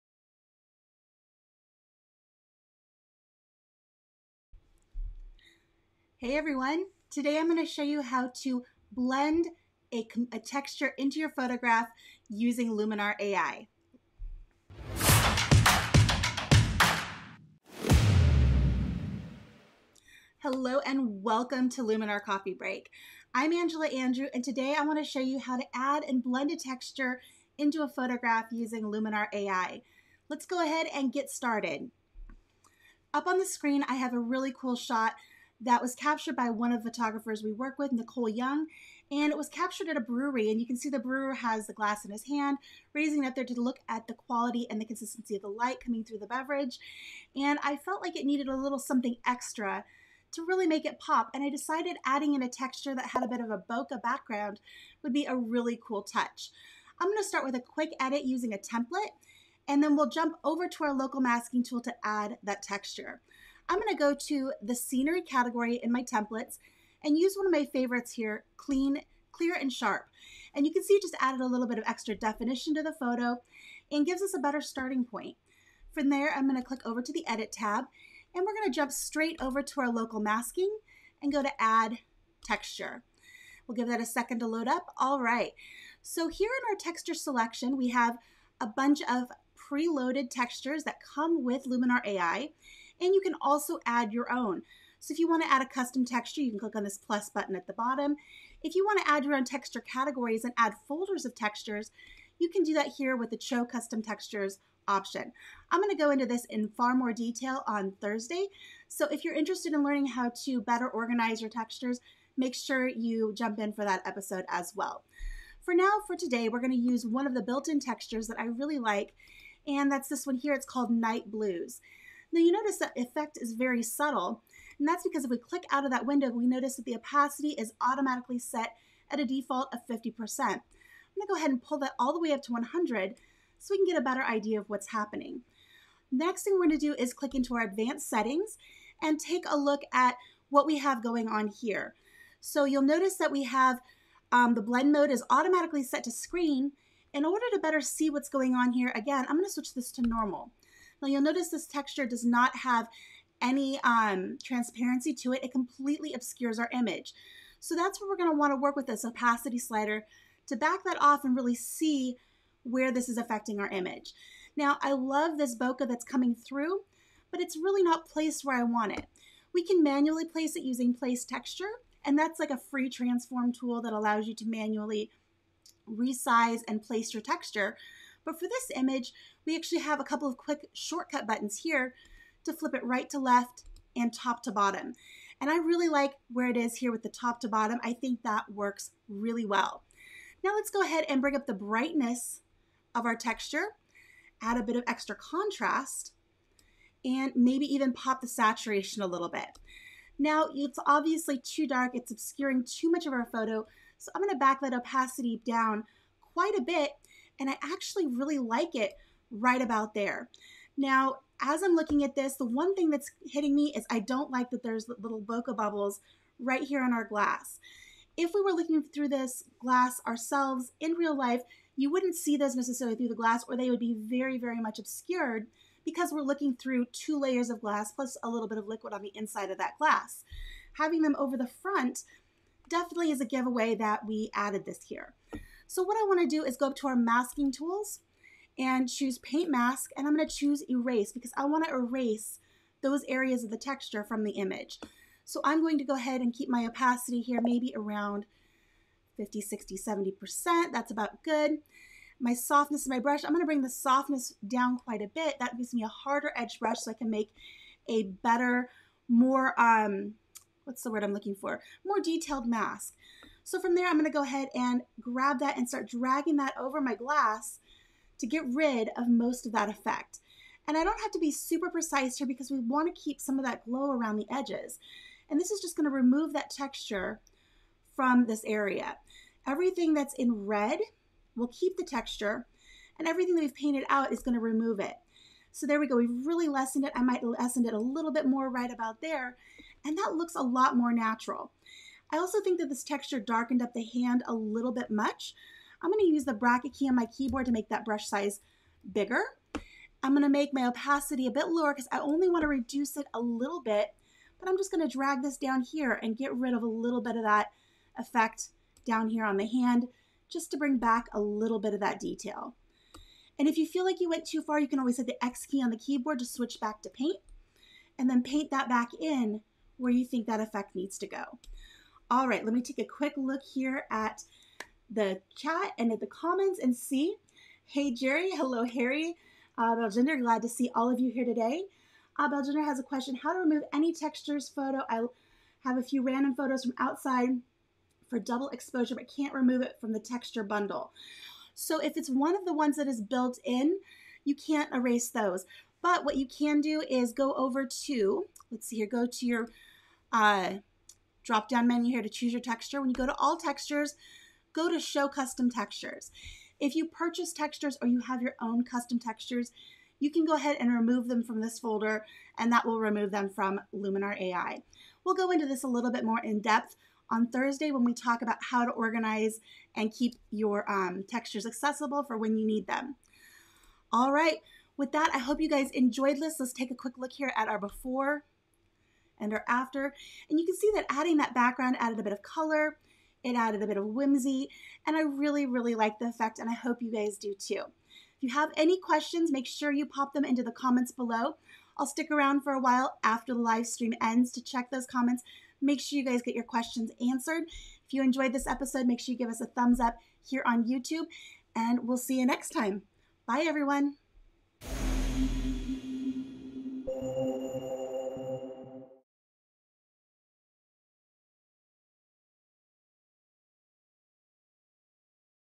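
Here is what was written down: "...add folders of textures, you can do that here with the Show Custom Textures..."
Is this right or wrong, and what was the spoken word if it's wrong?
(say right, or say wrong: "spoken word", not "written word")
right.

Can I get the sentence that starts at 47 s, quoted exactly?
And I felt like it needed a little something extra to really make it pop.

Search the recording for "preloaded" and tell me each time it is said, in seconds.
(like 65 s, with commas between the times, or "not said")
89 s.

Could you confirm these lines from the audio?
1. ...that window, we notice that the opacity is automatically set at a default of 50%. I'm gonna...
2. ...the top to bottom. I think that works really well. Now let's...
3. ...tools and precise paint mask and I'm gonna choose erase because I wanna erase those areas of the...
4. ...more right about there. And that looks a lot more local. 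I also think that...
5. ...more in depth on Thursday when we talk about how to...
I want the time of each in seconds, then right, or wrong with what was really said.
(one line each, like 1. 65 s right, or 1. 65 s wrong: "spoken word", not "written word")
1. 125 s right
2. 187 s right
3. 237 s wrong: "choose", not "precise"
4. 288 s wrong: "natural", not "local"
5. 366 s right.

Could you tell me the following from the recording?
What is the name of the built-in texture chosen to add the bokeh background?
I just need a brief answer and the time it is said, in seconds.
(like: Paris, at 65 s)
Night Blues, at 120 s.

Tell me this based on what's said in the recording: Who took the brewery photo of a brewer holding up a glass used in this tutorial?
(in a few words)
Nicole Young.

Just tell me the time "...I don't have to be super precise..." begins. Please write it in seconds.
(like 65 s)
270 s.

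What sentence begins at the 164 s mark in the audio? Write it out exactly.
Now, I love this bokeh that's coming through, but it's really not placed where I want it.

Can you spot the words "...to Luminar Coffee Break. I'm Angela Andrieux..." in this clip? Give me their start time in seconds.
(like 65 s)
21 s.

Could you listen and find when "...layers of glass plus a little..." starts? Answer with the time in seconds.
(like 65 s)
227 s.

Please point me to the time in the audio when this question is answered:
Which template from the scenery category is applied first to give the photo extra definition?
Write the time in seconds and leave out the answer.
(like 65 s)
68 s.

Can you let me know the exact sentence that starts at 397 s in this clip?
If you enjoyed this episode, make sure you give us a thumbs up here on YouTube, and we'll see you next time.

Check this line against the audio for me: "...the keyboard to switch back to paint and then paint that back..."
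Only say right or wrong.
right.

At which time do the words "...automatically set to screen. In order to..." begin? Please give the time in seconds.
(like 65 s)
145 s.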